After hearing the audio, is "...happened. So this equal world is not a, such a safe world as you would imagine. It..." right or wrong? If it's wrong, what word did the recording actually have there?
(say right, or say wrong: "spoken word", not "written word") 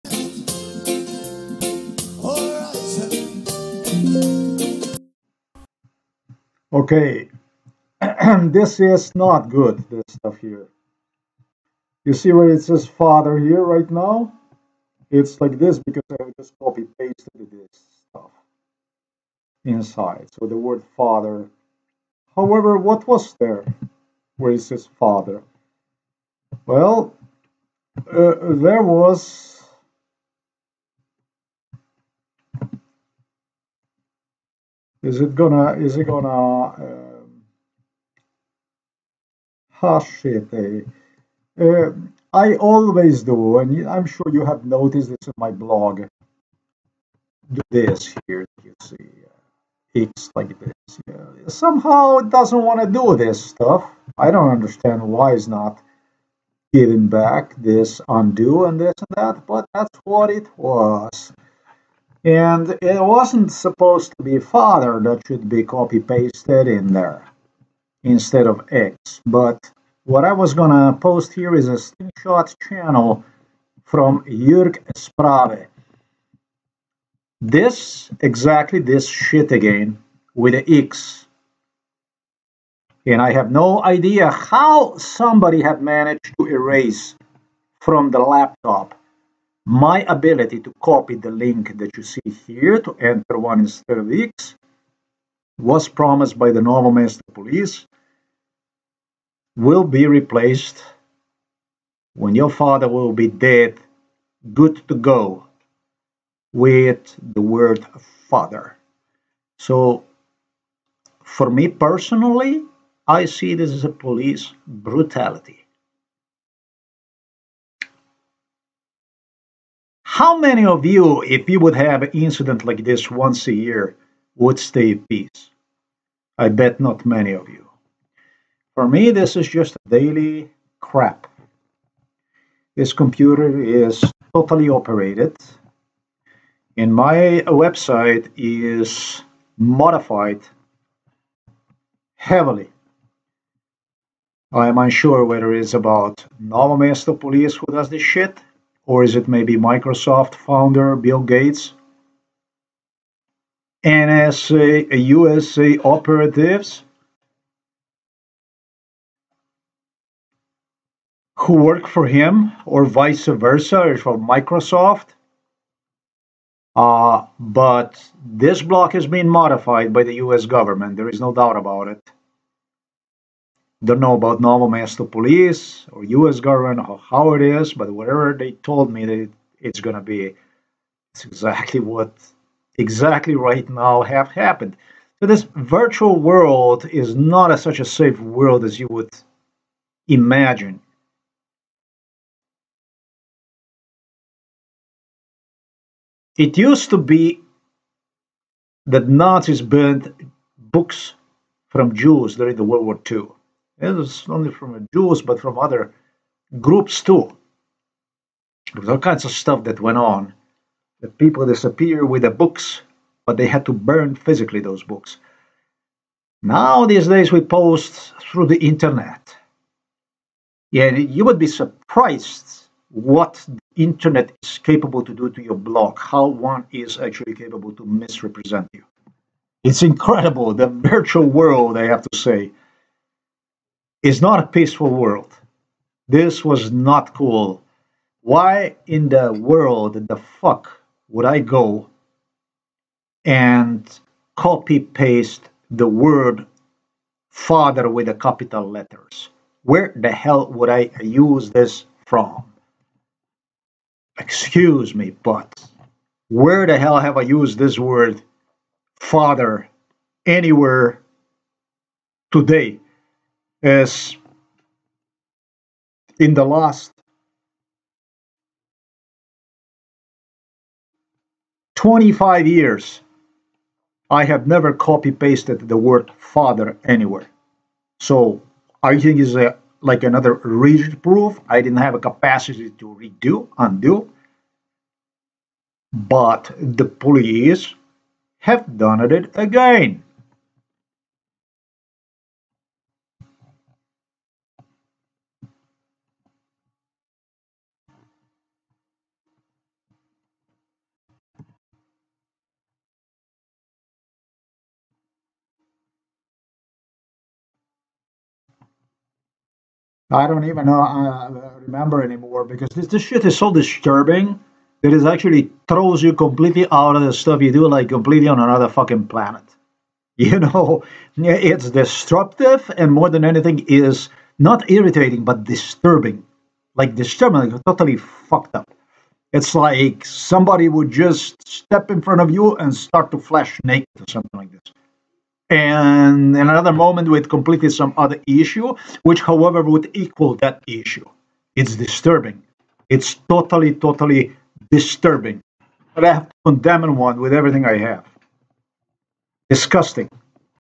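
wrong: "virtual", not "equal".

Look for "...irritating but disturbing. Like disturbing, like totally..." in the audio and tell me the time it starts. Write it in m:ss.
5:24.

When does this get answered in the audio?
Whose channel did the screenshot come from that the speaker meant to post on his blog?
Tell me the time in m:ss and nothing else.
1:14.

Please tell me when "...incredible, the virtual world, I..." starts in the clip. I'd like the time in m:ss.
3:49.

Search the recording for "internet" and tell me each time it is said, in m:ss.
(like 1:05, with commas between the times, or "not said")
3:38, 3:43.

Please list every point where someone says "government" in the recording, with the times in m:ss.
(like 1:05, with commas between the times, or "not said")
2:50, 2:56.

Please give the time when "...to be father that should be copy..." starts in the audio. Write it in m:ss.
1:04.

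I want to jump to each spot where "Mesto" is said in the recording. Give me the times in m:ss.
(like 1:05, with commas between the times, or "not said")
1:36, 2:26, 2:54.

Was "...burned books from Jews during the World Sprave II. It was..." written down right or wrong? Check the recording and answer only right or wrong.
wrong.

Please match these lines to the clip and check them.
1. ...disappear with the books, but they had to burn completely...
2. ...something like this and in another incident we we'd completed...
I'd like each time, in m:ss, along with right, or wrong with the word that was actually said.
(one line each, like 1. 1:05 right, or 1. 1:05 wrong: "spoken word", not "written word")
1. 3:31 wrong: "physically", not "completely"
2. 5:34 wrong: "moment", not "incident".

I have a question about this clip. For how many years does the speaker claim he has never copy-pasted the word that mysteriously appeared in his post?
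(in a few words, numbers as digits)
25.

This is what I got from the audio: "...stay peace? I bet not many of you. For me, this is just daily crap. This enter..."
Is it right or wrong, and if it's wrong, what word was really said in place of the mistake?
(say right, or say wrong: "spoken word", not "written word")
wrong: "computer", not "enter".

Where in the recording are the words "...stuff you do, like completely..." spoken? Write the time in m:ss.
5:17.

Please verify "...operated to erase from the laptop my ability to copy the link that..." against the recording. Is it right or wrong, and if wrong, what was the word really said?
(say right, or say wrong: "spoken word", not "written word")
wrong: "managed", not "operated".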